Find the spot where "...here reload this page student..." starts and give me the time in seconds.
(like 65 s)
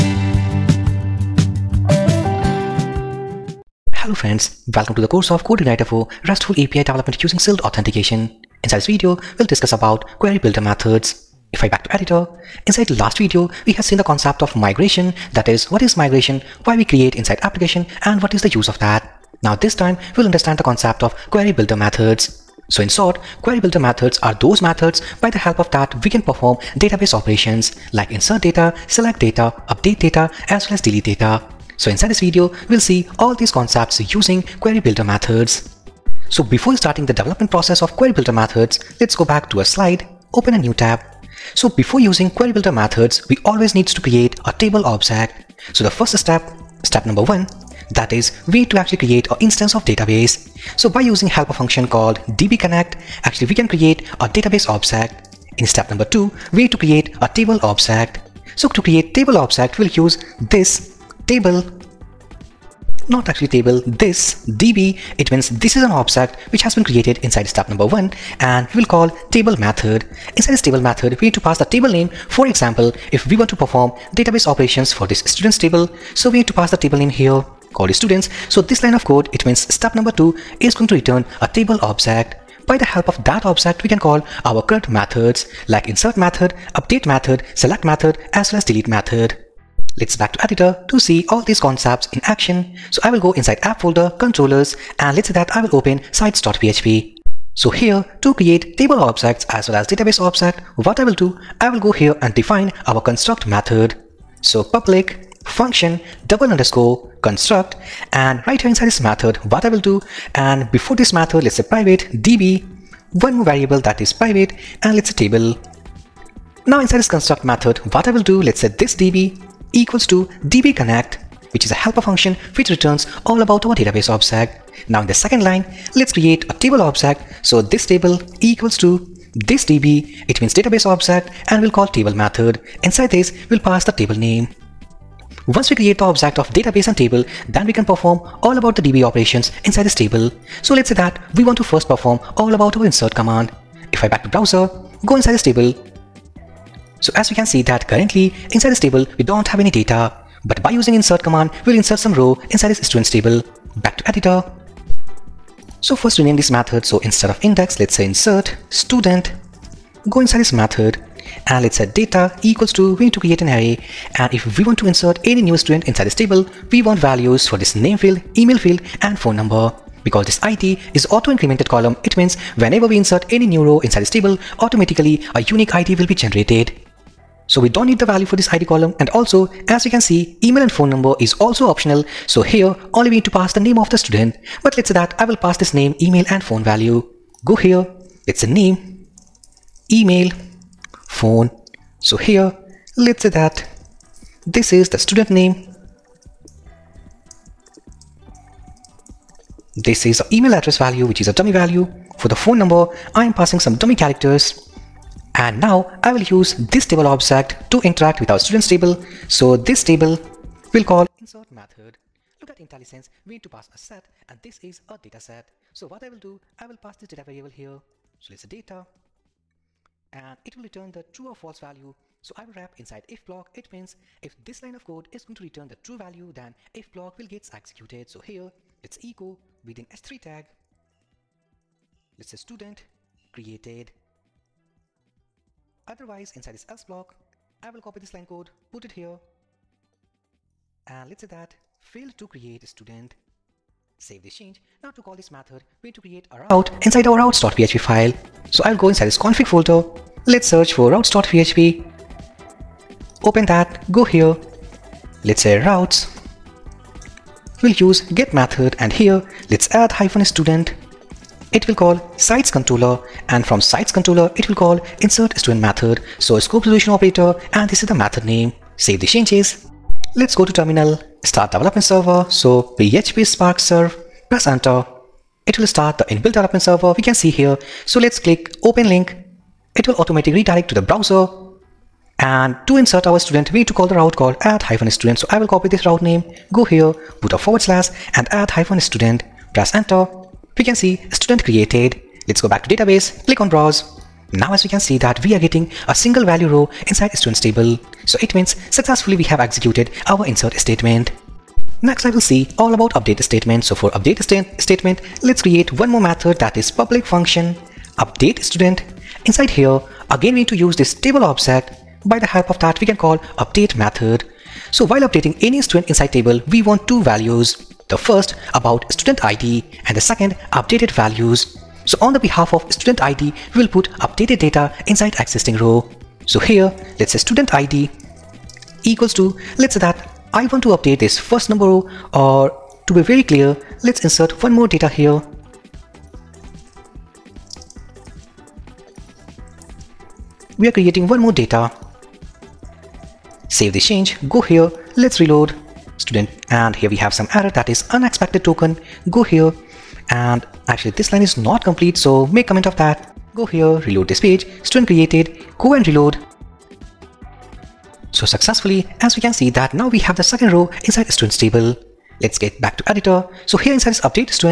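353 s.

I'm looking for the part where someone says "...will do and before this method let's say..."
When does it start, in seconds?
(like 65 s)
109 s.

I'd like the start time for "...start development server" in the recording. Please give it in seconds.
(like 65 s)
271 s.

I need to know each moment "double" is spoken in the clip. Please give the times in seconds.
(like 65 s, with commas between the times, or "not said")
106 s.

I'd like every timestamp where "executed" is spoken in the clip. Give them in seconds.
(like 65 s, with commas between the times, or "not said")
227 s, 299 s.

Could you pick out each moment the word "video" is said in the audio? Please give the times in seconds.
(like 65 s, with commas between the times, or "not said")
8 s, 13 s, 32 s.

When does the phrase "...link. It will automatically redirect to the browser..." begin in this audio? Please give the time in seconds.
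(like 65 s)
278 s.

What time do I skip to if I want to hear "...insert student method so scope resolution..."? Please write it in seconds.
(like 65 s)
265 s.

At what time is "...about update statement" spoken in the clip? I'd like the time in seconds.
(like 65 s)
302 s.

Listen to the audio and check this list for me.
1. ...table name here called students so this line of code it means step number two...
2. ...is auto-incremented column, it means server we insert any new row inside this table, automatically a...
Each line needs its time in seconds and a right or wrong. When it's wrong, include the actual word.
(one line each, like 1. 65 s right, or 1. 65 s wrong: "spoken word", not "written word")
1. 76 s right
2. 170 s wrong: "whenever", not "server".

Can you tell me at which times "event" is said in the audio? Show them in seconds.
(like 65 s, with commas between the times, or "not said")
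not said.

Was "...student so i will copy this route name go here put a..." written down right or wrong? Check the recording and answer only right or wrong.
right.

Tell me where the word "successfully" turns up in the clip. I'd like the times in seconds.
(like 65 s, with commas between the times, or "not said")
298 s, 358 s.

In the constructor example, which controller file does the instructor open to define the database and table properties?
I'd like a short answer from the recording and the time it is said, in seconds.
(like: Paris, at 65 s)
sites.php, at 96 s.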